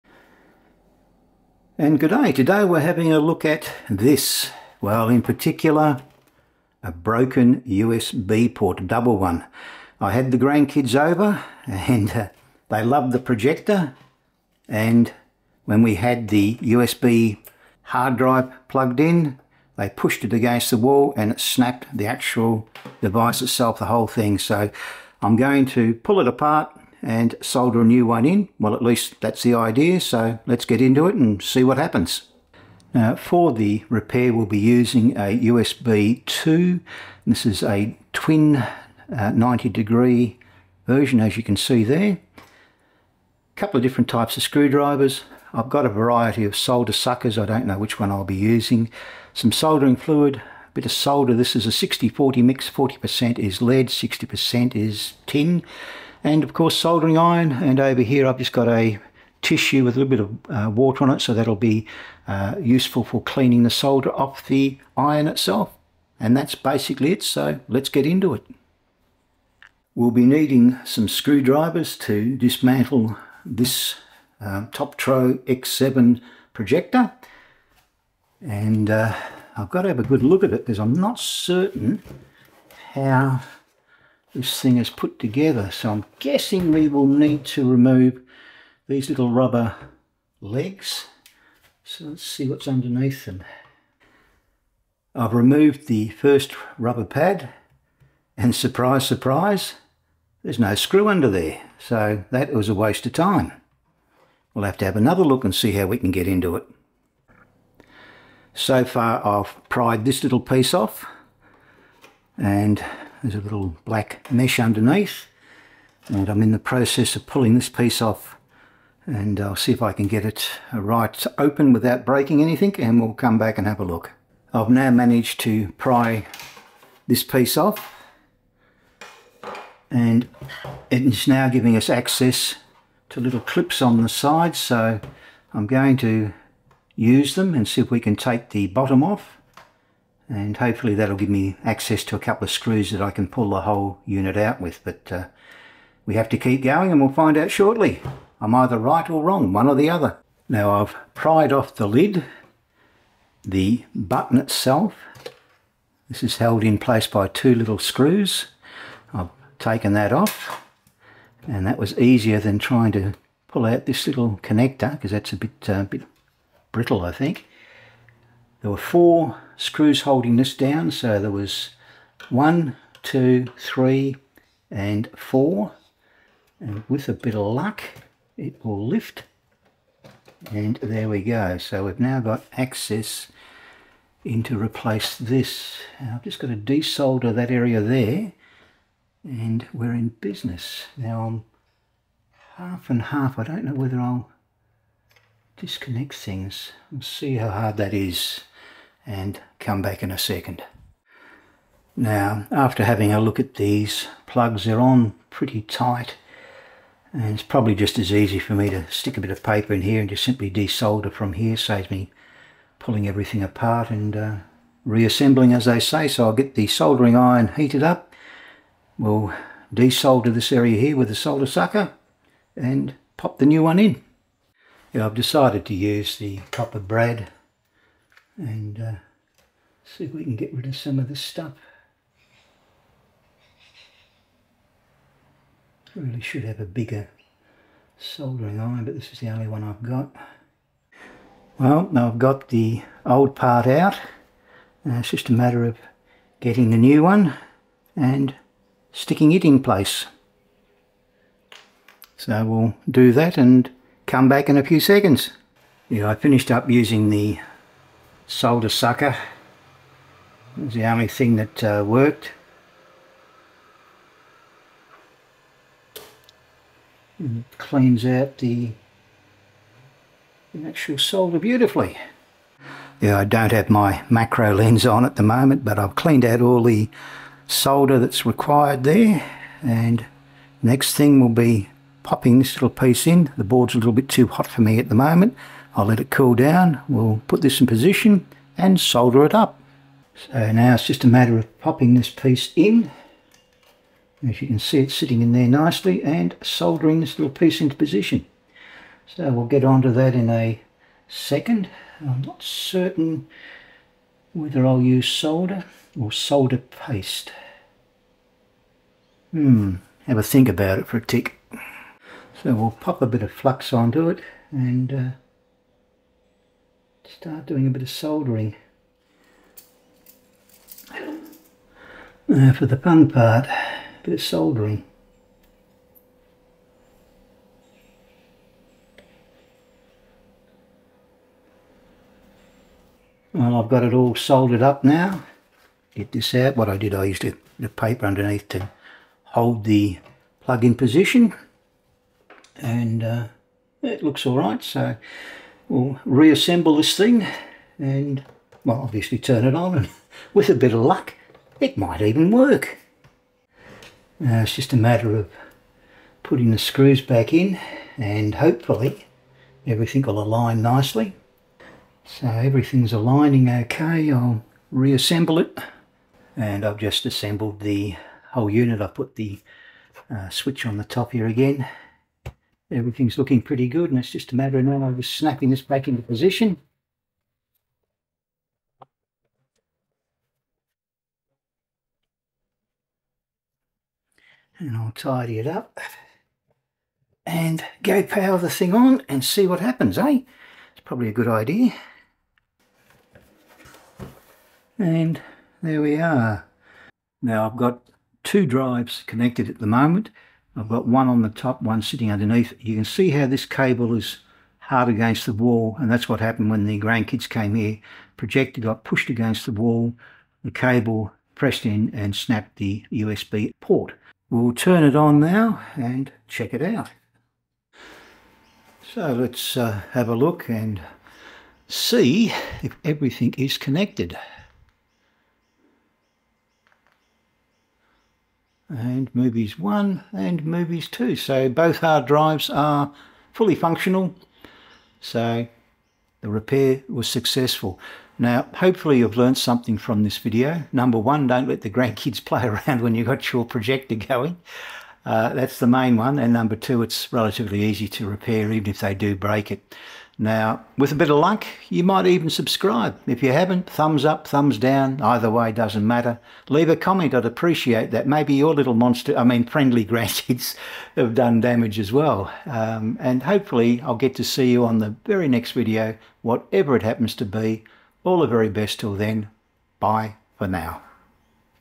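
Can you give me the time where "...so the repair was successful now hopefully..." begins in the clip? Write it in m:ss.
7:14.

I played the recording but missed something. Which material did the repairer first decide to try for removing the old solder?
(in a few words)
copper braid.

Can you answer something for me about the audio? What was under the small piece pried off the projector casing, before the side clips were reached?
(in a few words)
a little black mesh.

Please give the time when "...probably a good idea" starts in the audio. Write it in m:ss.
6:30.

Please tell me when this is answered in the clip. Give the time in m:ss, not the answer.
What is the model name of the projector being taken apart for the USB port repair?
1:14.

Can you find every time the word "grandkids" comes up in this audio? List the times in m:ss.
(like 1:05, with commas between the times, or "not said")
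0:10, 6:46, 7:21, 7:39.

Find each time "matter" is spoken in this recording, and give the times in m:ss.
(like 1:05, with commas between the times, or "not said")
4:05, 4:51, 5:54, 6:14, 7:35.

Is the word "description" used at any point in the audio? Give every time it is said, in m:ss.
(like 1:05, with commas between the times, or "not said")
not said.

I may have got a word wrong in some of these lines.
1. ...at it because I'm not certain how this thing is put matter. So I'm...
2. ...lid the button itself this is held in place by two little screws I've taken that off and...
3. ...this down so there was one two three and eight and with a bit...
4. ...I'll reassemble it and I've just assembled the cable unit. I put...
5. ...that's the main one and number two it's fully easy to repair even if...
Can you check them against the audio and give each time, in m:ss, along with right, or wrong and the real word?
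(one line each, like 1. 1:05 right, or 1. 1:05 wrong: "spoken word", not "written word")
1. 1:20 wrong: "together", not "matter"
2. 2:31 right
3. 2:50 wrong: "four", not "eight"
4. 6:04 wrong: "whole", not "cable"
5. 7:25 wrong: "relatively", not "fully".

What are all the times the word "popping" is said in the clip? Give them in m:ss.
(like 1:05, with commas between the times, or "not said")
4:42, 4:51.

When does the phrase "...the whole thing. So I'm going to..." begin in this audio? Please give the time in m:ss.
0:23.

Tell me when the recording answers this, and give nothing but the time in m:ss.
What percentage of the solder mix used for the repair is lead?
0:52.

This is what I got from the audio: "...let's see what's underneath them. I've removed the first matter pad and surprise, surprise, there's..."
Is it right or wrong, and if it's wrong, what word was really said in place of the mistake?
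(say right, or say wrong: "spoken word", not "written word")
wrong: "rubber", not "matter".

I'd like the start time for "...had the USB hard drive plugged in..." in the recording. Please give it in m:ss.
0:15.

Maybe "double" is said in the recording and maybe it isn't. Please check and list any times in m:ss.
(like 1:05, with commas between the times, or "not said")
0:08.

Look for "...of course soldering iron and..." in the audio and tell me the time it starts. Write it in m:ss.
0:56.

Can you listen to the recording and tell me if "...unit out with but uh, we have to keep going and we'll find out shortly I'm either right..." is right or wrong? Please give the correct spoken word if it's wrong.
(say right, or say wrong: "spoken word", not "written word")
right.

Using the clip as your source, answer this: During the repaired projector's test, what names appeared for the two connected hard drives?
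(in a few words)
Movies 1 and Movies 2.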